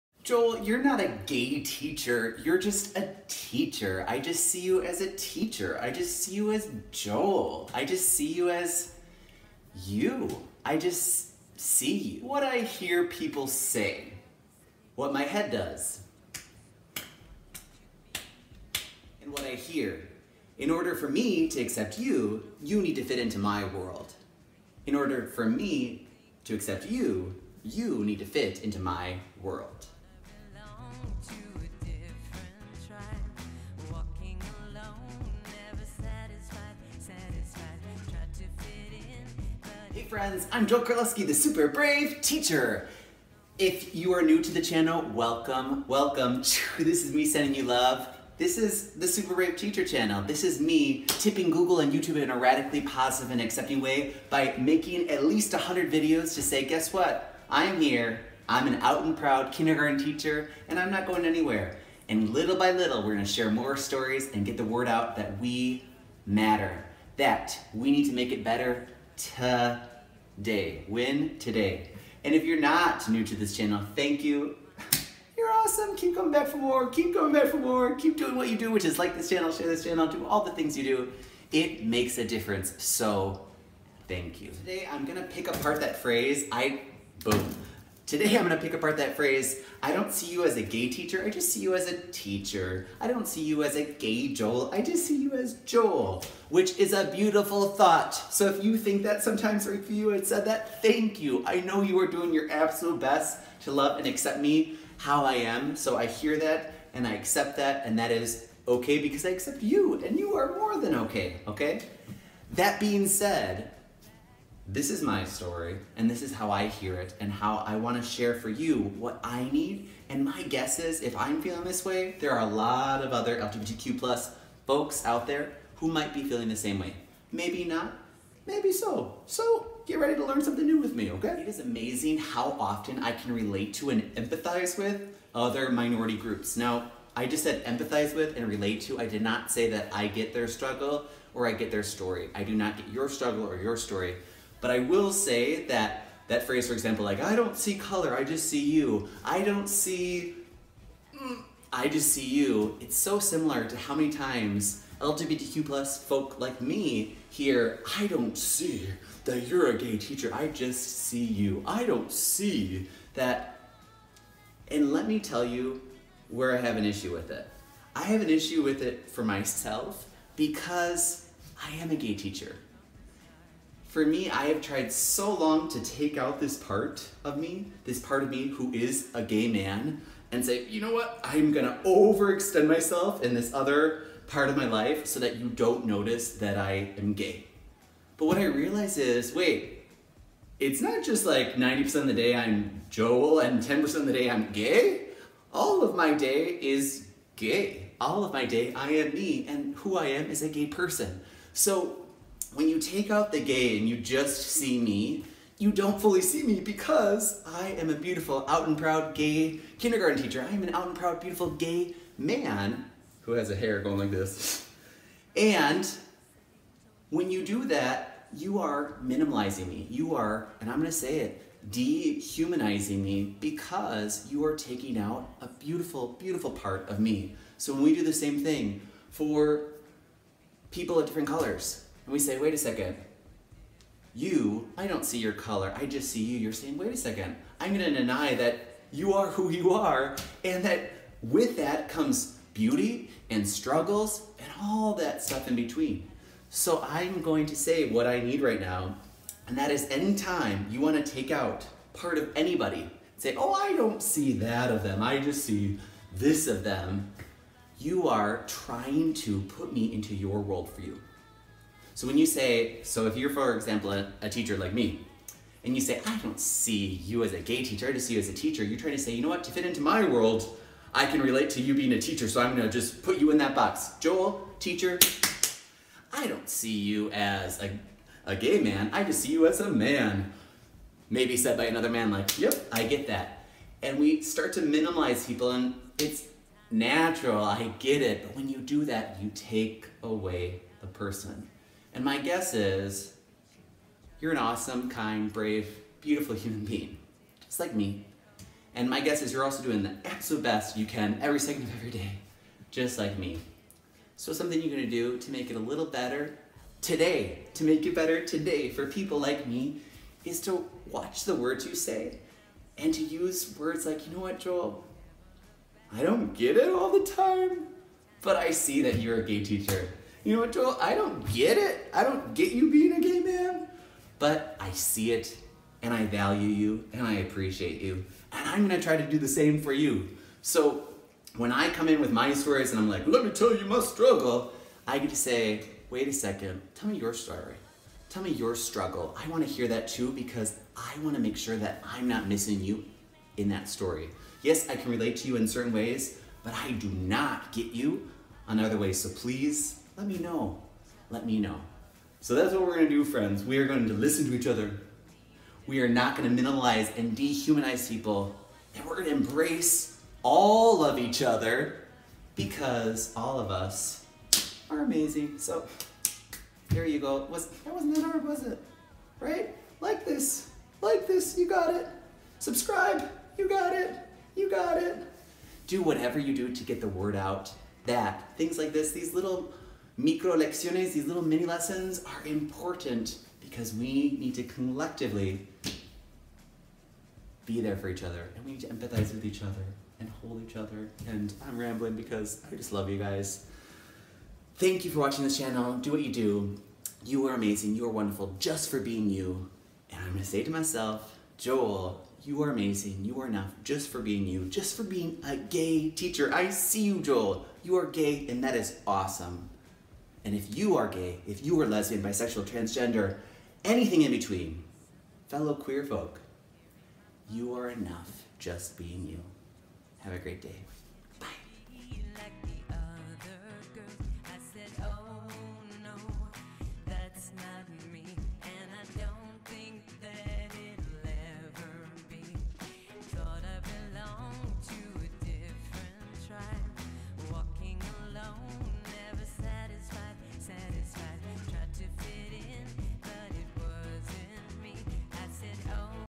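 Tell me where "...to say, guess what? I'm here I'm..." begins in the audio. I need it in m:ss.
0:56.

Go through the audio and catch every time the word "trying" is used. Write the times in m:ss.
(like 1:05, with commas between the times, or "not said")
4:18, 4:28.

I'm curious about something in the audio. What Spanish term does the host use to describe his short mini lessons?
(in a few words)
Micro lecciones.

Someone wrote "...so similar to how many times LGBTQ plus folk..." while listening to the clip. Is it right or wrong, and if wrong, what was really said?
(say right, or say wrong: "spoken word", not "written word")
right.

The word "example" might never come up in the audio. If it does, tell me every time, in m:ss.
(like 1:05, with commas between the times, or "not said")
2:26, 4:23.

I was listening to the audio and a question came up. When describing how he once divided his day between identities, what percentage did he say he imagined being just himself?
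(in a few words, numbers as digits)
90%.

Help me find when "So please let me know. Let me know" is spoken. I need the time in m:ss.
5:48.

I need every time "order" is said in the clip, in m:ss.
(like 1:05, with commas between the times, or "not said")
0:20, 0:24.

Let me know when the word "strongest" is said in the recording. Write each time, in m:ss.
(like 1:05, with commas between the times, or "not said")
not said.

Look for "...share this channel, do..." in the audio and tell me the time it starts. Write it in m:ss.
1:19.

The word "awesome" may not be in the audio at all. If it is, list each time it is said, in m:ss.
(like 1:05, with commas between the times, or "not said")
1:15, 4:54, 6:48.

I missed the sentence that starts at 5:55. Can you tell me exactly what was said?
We are not going to minimize and dehumanize people.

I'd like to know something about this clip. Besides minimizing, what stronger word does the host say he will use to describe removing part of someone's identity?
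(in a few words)
Dehumanizing.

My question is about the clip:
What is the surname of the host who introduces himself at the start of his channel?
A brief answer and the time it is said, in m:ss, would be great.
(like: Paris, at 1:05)
Carlovsky, at 0:40.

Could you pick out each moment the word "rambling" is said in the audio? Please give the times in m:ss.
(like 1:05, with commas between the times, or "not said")
6:31.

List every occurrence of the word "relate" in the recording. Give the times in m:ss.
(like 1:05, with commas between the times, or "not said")
2:13, 2:18, 4:31, 5:44.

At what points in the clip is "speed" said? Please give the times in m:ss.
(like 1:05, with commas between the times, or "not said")
not said.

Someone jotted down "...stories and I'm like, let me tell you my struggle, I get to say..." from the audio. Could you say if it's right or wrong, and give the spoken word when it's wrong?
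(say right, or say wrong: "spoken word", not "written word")
right.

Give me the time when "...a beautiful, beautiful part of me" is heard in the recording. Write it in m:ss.
3:45.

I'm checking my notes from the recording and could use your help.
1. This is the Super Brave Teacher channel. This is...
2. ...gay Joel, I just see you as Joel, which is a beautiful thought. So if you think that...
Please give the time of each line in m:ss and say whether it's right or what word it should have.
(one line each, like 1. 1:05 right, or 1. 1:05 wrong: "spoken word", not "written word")
1. 0:48 right
2. 1:33 right.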